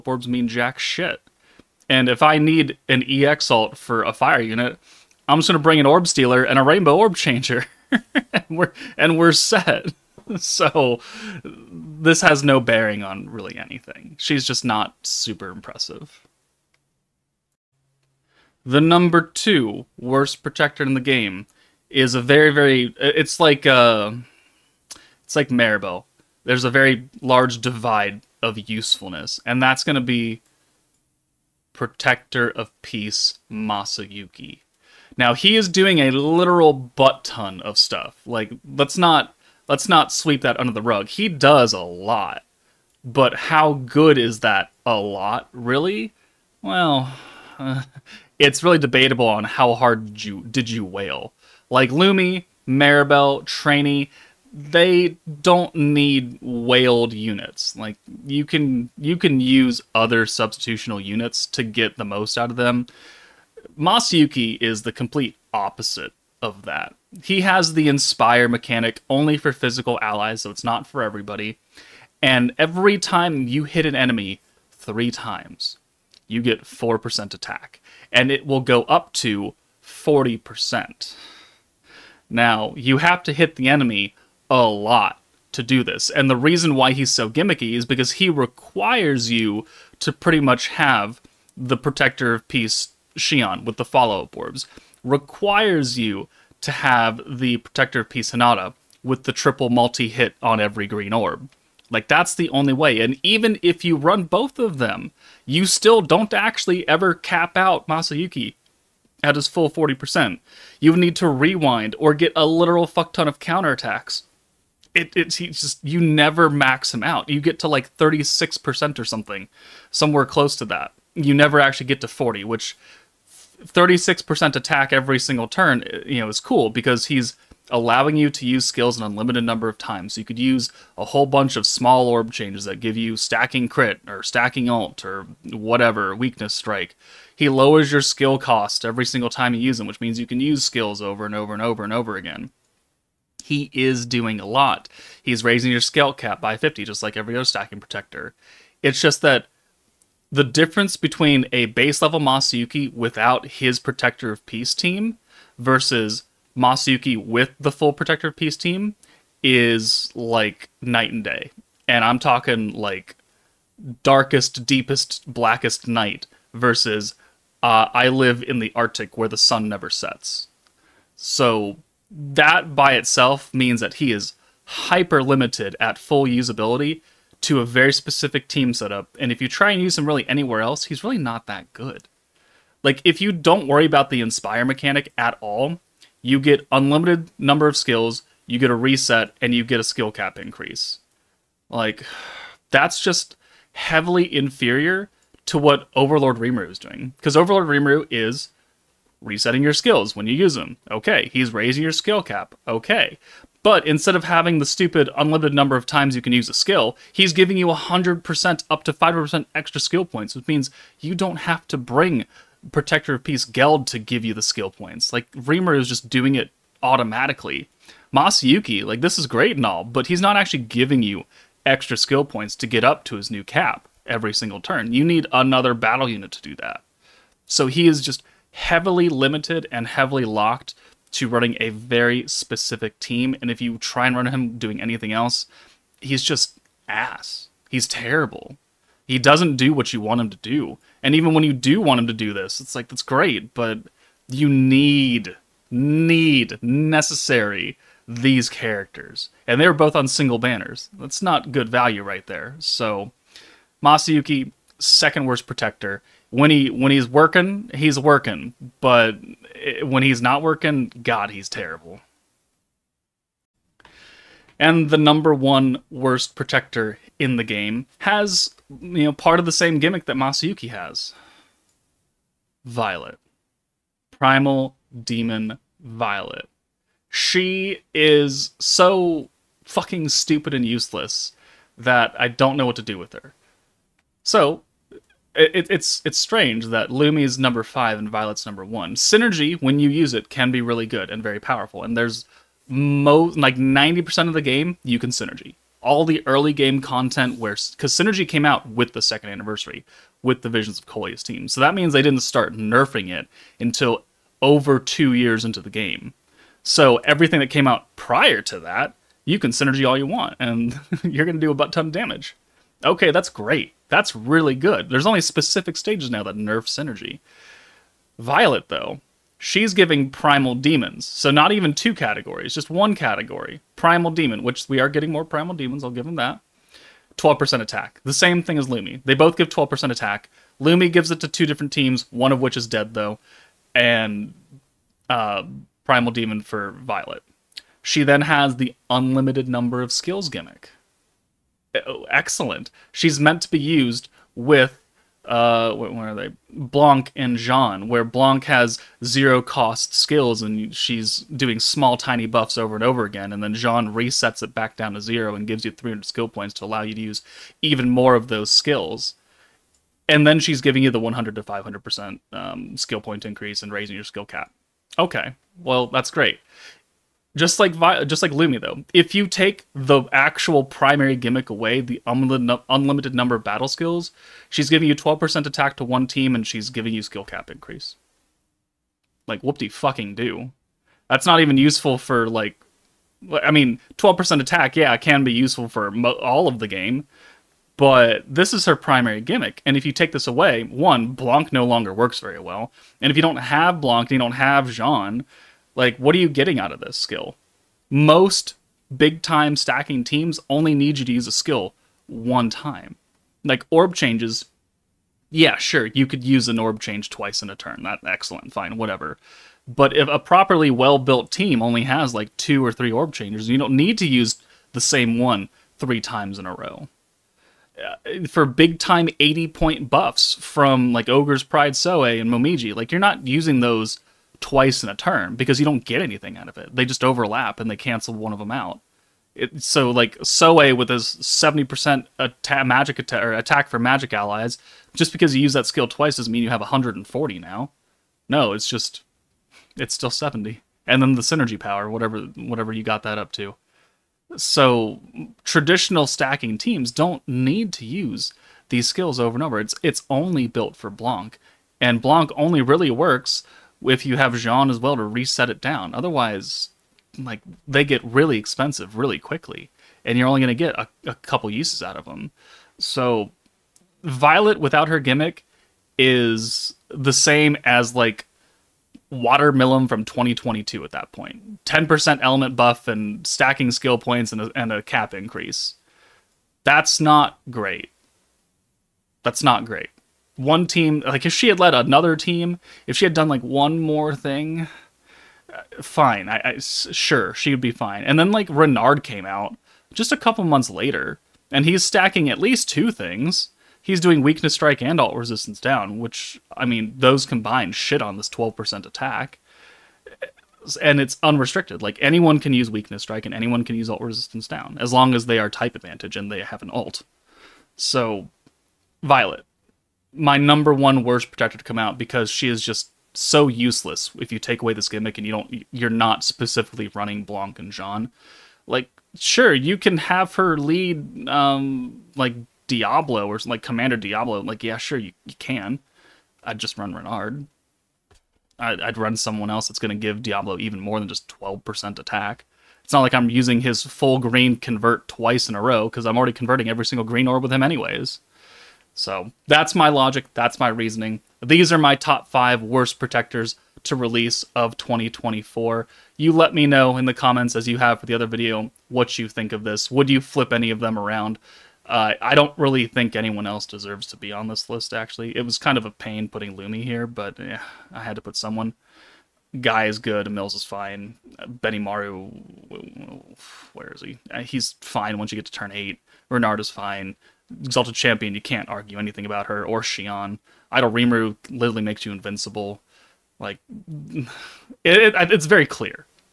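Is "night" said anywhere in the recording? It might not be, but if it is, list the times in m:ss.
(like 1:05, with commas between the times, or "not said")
2:40, 2:45.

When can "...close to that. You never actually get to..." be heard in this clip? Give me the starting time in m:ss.
2:00.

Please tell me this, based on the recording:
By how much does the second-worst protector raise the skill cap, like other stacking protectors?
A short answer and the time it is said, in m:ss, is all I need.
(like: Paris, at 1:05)
50, at 2:26.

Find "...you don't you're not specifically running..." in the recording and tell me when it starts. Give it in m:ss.
8:35.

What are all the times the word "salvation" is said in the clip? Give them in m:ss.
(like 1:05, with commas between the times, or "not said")
not said.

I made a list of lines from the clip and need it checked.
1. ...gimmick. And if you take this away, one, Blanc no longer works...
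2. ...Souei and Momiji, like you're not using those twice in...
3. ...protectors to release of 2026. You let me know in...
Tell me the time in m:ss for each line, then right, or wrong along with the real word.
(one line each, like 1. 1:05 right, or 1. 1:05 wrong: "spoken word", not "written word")
1. 6:29 right
2. 7:01 right
3. 9:02 wrong: "2024", not "2026".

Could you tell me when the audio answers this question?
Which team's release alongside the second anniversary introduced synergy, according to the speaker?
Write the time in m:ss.
5:00.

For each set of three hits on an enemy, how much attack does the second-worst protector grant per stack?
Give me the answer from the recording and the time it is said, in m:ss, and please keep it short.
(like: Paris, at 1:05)
4%, at 1:16.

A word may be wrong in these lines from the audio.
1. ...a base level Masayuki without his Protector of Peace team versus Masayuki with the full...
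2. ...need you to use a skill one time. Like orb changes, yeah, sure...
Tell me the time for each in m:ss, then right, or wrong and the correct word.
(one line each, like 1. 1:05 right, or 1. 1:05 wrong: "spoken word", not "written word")
1. 2:31 right
2. 6:40 right.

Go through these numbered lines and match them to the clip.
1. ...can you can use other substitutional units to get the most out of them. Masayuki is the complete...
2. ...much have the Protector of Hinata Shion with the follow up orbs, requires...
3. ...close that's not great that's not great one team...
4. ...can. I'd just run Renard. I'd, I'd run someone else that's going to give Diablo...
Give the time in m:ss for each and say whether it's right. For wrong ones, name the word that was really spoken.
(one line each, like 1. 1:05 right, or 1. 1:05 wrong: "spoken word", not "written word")
1. 0:58 right
2. 1:30 wrong: "Peace", not "Hinata"
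3. 7:55 wrong: "increase", not "close"
4. 8:45 right.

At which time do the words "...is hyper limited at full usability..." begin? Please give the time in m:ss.
2:54.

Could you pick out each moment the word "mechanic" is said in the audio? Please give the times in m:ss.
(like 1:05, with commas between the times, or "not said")
1:08, 3:04.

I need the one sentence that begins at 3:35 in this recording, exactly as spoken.
Like, Rimuru is just doing it automatically.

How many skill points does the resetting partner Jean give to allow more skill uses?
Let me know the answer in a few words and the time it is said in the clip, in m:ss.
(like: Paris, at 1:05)
300, at 5:55.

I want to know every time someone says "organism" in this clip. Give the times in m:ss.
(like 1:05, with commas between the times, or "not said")
not said.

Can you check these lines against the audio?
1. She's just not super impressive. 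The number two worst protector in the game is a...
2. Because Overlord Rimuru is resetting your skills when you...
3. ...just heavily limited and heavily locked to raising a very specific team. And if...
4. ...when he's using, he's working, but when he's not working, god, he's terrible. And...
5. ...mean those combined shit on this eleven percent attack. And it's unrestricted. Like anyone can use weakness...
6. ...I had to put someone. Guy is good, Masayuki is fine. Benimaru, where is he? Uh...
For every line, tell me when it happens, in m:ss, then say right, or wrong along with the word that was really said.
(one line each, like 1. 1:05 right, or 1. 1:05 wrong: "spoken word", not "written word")
1. 0:14 right
2. 3:17 right
3. 3:48 wrong: "running", not "raising"
4. 4:16 wrong: "working", not "using"
5. 8:16 wrong: "twelve", not "eleven"
6. 9:17 wrong: "Mills", not "Masayuki".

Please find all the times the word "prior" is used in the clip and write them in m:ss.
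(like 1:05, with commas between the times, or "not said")
5:07.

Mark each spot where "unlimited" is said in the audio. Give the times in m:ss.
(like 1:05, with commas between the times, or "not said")
2:09, 3:06, 3:25, 5:38, 6:12.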